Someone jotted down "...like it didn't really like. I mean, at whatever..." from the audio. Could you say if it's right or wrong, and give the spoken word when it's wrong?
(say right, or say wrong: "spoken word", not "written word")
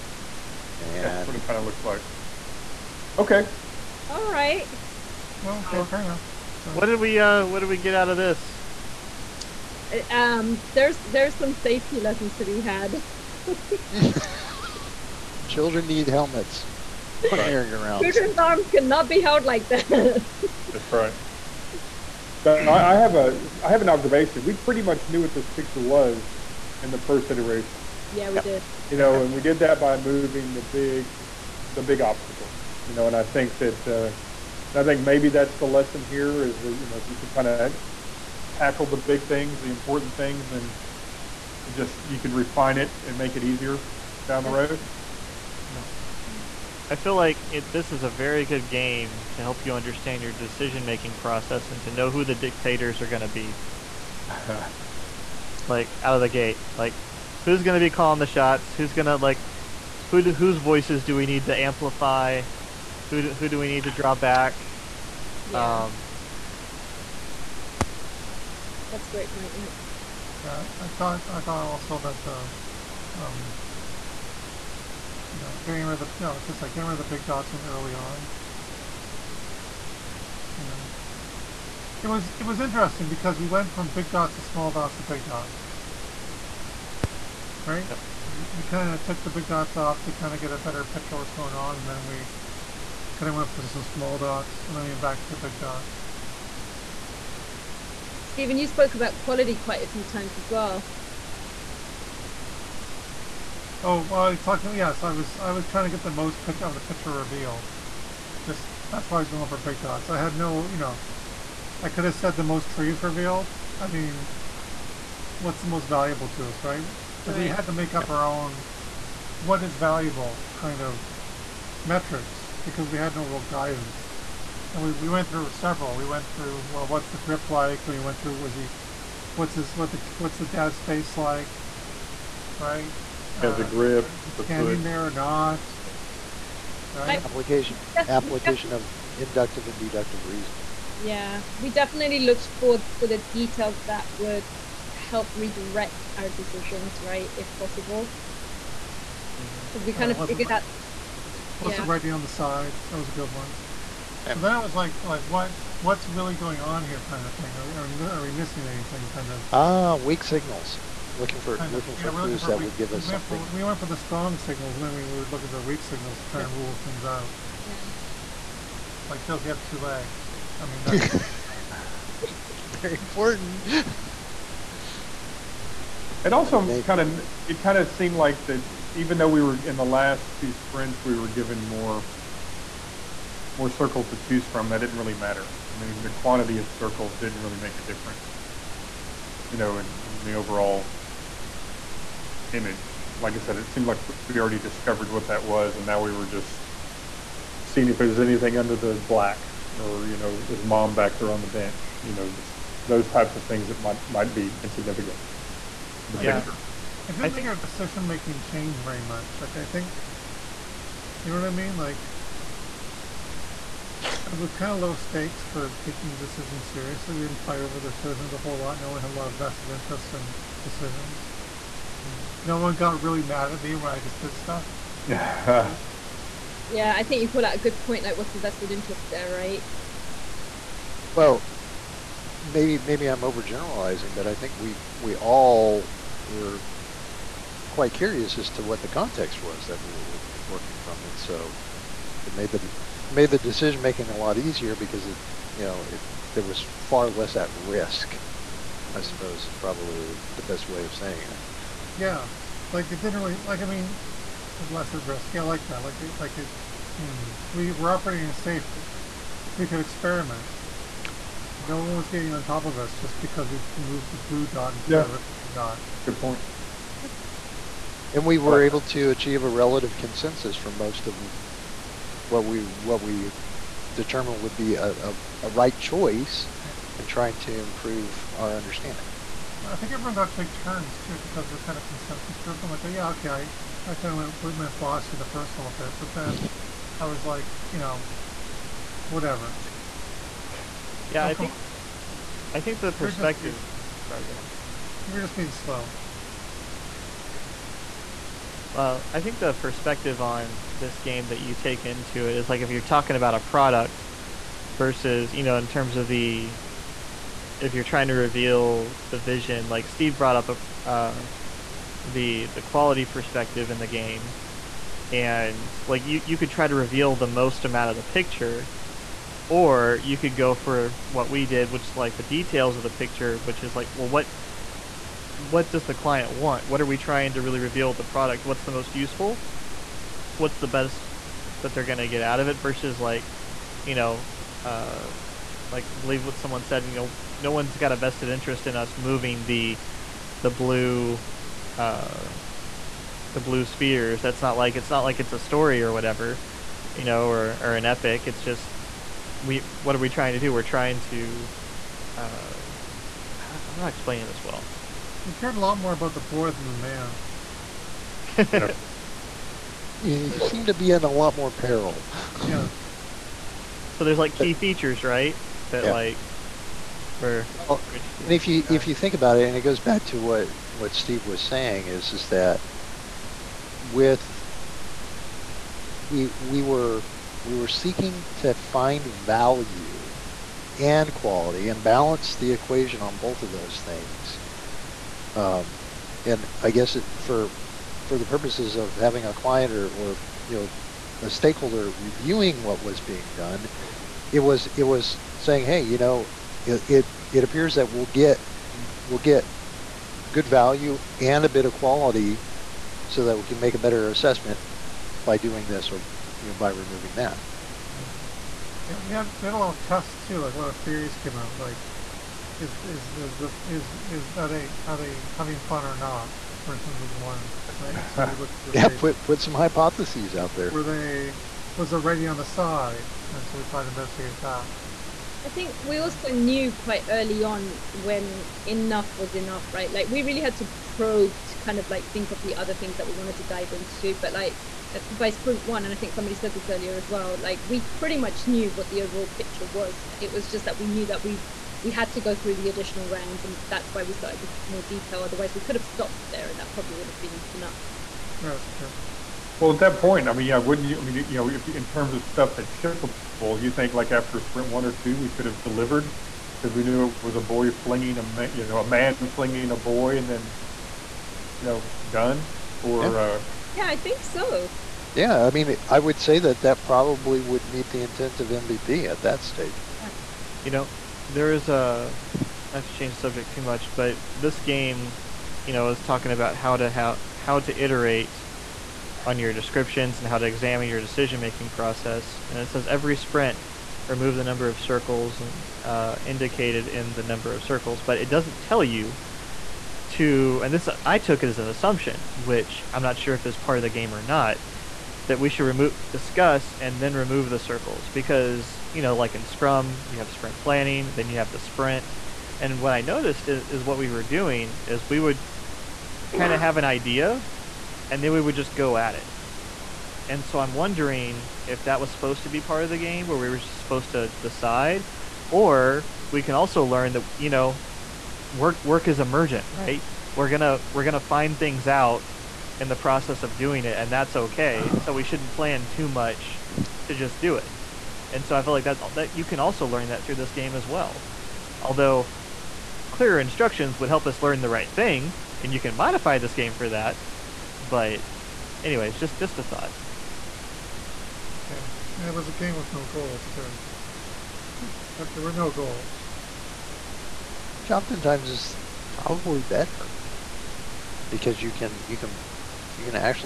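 wrong: "lesser", not "whatever".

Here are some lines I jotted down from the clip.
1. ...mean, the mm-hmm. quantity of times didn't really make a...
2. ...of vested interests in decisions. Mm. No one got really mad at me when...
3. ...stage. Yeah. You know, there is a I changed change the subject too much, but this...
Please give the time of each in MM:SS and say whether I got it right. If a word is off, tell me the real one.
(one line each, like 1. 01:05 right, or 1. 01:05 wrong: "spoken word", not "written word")
1. 03:05 wrong: "circles", not "times"
2. 03:39 right
3. 07:49 right.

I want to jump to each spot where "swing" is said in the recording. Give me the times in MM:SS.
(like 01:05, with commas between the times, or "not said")
not said.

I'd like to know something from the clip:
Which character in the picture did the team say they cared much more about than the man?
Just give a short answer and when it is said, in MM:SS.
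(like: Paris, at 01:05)
the boy, at 05:56.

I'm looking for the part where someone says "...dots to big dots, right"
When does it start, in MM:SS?
01:24.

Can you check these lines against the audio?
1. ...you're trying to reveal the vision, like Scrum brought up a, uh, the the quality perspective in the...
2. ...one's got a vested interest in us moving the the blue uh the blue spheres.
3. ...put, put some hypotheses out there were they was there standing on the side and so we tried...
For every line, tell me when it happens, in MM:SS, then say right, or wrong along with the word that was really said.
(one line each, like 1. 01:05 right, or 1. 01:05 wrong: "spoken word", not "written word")
1. 05:07 wrong: "Steve", not "Scrum"
2. 05:37 right
3. 06:58 wrong: "writing", not "standing".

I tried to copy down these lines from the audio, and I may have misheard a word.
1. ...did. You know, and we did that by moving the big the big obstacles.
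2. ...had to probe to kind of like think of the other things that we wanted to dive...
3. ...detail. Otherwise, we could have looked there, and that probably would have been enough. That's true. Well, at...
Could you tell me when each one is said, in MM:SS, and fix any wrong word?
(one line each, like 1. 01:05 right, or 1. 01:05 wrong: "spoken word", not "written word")
1. 00:28 right
2. 07:10 right
3. 07:24 wrong: "stopped", not "looked".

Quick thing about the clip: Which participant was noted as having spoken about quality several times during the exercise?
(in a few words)
Stephen.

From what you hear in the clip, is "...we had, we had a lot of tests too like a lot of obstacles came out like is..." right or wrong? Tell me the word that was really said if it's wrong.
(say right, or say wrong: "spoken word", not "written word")
wrong: "theories", not "obstacles".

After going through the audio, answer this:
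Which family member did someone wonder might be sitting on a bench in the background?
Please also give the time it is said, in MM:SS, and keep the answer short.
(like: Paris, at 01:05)
mom, at 03:20.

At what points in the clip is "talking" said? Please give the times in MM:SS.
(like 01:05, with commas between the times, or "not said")
01:44, 05:02, 07:56.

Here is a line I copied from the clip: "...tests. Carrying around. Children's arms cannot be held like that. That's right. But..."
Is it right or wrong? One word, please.
wrong.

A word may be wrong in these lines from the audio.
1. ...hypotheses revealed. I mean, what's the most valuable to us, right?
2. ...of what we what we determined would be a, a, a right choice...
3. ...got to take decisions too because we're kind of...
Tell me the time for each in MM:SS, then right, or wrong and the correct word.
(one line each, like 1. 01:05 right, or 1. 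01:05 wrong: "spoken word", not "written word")
1. 01:52 wrong: "trees", not "hypotheses"
2. 04:31 right
3. 04:40 wrong: "turns", not "decisions".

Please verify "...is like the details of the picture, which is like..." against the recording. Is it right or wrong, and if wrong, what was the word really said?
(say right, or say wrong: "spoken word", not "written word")
right.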